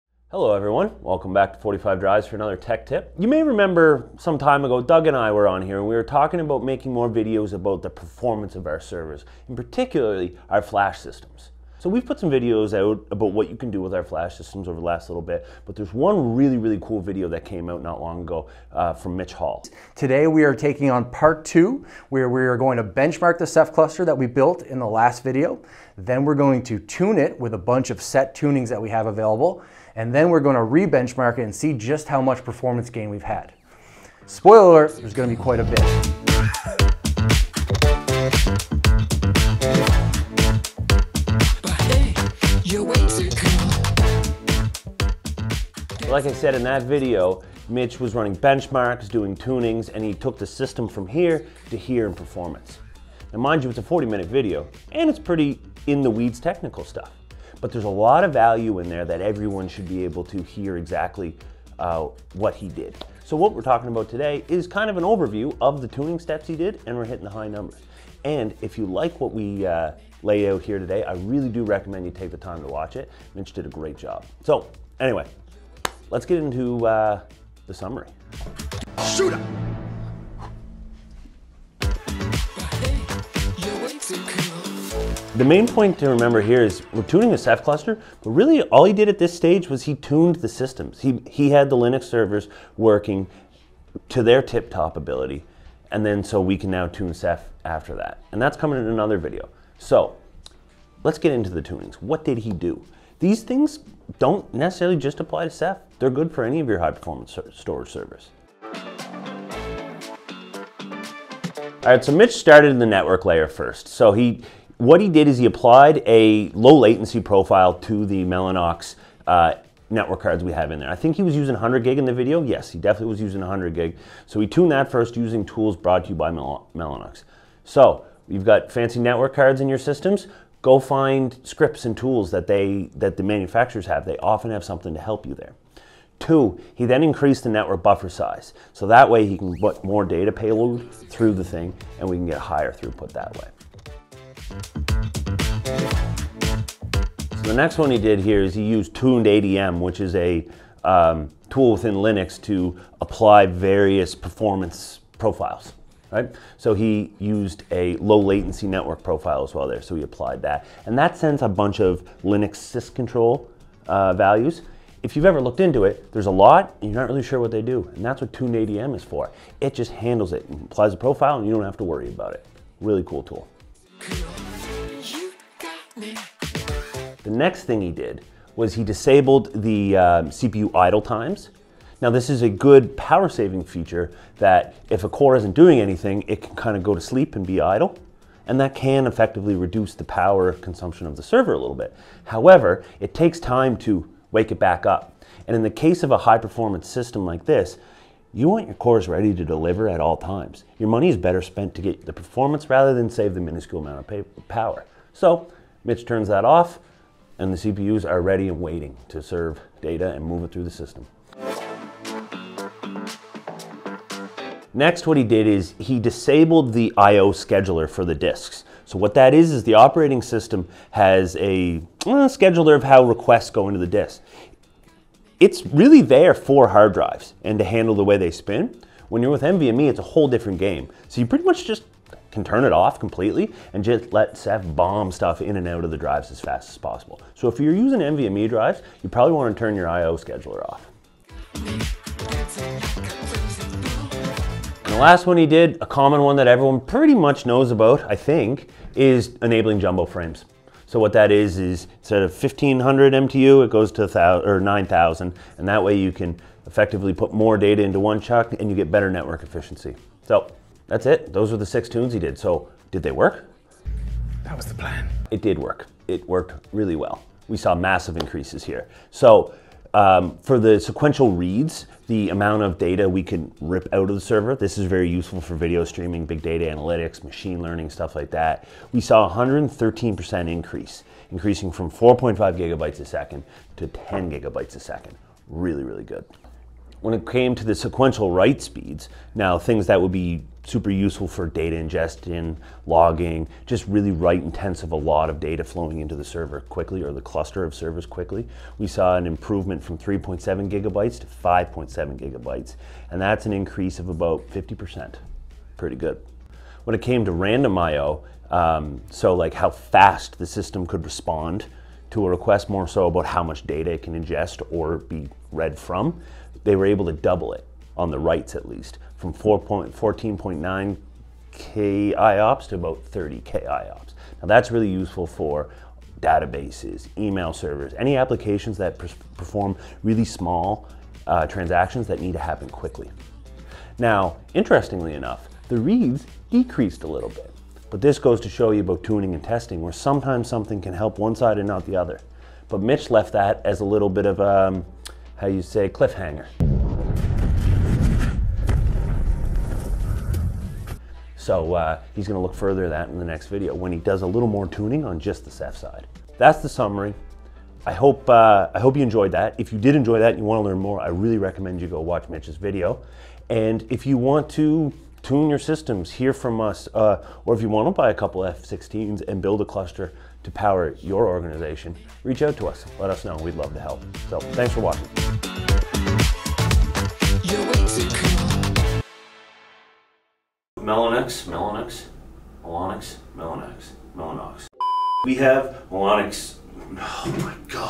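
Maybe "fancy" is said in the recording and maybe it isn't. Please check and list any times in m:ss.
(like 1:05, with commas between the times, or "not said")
2:08.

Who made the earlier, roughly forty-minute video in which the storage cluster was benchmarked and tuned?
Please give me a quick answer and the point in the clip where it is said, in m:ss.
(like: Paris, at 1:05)
Mitch Hall, at 0:19.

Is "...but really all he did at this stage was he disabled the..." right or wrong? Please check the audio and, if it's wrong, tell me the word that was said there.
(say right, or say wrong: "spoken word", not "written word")
wrong: "tuned", not "disabled".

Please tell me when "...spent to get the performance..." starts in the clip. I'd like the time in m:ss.
3:21.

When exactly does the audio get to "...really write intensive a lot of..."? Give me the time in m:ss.
4:53.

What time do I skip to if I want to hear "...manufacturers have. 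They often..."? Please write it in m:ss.
2:13.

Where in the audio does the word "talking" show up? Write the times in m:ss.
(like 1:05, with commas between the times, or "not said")
0:06, 1:03.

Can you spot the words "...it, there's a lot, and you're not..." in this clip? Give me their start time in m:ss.
2:45.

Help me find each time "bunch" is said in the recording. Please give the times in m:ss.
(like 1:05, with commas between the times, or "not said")
0:27, 2:41.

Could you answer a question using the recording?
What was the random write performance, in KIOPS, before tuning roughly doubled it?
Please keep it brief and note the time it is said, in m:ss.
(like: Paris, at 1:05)
14.9 KIOPS, at 5:19.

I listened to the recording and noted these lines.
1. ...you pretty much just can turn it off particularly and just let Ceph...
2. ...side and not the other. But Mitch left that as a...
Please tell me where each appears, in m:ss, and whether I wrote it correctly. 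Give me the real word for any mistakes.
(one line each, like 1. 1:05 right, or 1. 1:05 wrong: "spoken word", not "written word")
1. 3:51 wrong: "completely", not "particularly"
2. 5:41 right.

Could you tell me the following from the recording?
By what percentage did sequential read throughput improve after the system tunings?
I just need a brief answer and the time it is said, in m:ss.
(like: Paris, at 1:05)
113%, at 4:39.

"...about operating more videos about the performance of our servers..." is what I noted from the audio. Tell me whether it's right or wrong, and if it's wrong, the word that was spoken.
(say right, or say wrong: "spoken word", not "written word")
wrong: "making", not "operating".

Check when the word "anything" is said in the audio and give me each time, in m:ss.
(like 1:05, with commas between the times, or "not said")
3:05.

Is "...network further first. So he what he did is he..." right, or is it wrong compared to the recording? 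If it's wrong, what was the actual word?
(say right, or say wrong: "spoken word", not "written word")
wrong: "layer", not "further".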